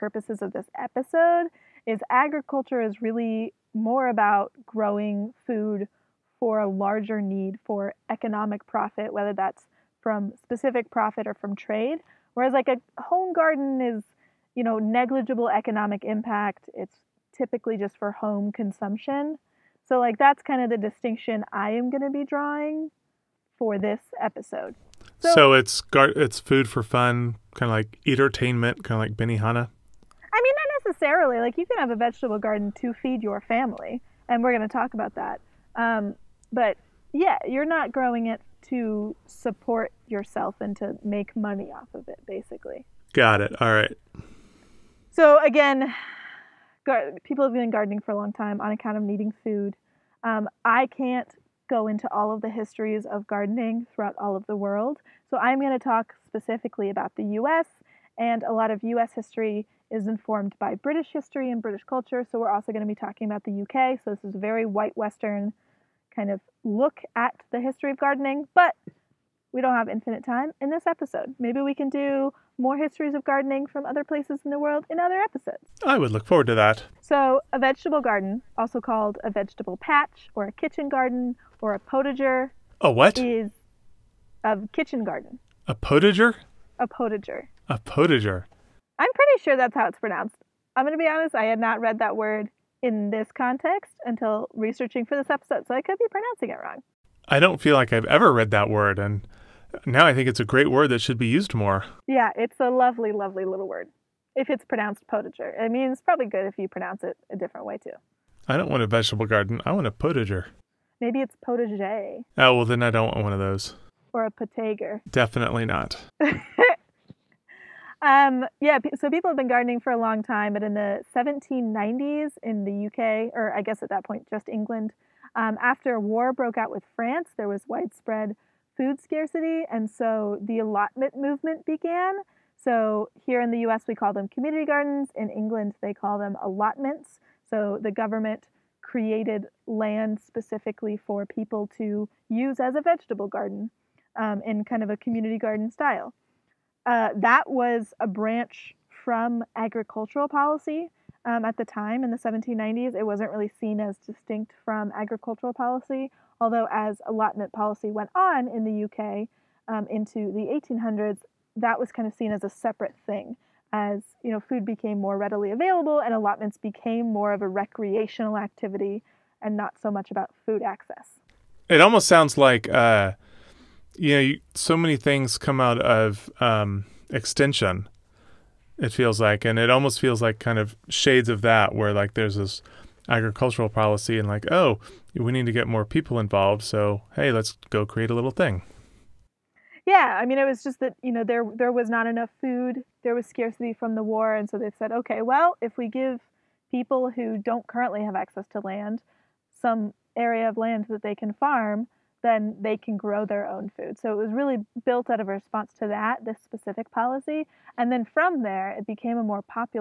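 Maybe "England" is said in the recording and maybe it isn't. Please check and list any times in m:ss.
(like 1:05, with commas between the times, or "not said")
2:04, 2:15.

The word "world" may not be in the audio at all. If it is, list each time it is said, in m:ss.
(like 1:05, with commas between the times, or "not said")
0:54, 1:14.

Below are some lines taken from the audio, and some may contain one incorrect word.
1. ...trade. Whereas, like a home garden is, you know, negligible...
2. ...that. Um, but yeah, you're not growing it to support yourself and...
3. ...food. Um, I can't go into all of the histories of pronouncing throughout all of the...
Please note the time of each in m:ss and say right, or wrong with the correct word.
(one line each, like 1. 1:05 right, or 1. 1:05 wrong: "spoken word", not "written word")
1. 0:11 right
2. 0:35 right
3. 0:49 wrong: "gardening", not "pronouncing".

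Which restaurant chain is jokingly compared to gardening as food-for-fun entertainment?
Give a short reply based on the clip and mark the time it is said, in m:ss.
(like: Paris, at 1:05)
Benihana, at 0:29.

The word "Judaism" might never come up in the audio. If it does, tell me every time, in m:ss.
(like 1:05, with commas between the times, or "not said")
not said.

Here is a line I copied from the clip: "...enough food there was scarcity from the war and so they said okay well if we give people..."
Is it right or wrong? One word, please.
right.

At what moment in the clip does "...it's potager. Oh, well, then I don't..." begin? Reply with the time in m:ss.
1:51.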